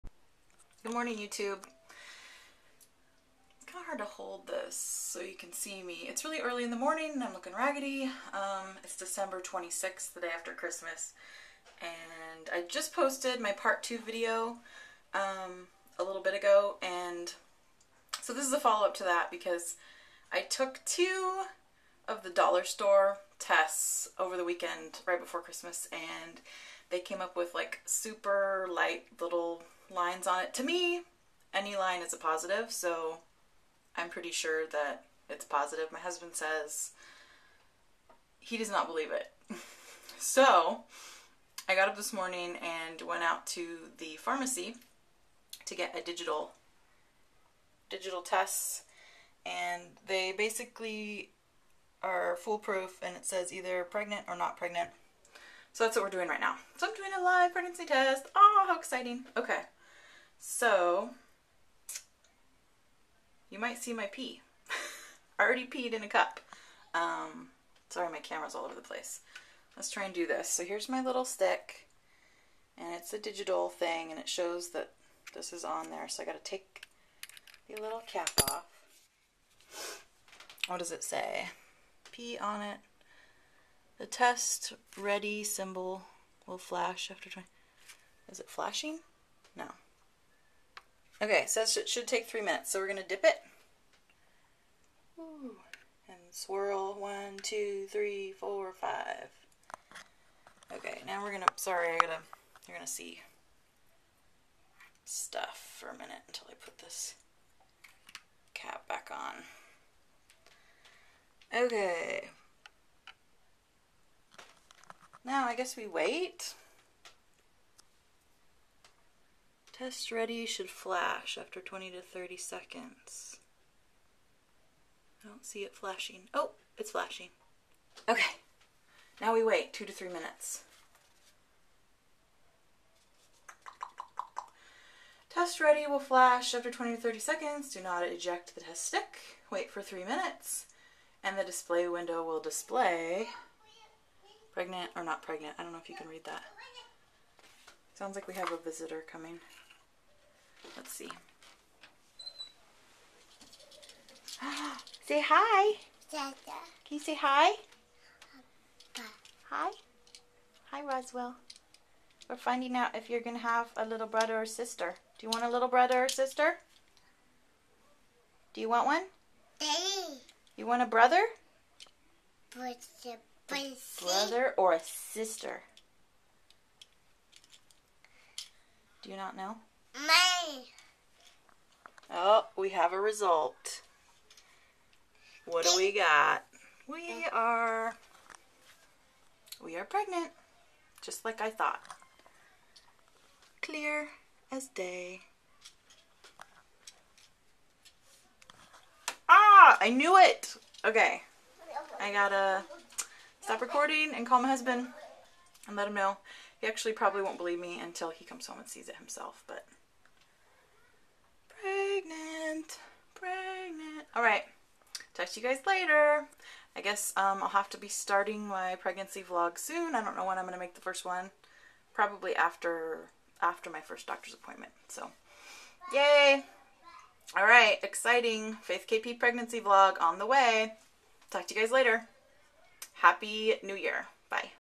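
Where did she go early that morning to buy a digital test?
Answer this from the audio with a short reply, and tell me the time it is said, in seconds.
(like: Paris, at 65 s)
The pharmacy, at 44 s.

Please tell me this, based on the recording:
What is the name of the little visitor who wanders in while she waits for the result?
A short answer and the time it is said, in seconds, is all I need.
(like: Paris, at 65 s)
Roswell, at 160 s.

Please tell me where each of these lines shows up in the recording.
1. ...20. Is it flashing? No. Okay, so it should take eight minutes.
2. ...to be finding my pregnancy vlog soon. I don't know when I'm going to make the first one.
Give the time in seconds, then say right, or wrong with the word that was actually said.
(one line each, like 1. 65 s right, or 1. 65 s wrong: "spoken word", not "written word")
1. 87 s wrong: "three", not "eight"
2. 217 s wrong: "starting", not "finding".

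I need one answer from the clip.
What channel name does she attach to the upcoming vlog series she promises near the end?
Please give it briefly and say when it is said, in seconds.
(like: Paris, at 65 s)
Faith KP, at 228 s.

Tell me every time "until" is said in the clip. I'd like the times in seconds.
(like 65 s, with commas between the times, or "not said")
106 s, 207 s.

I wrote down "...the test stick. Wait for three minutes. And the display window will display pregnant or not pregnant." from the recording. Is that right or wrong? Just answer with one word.
right.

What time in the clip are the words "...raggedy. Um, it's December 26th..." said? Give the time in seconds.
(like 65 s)
7 s.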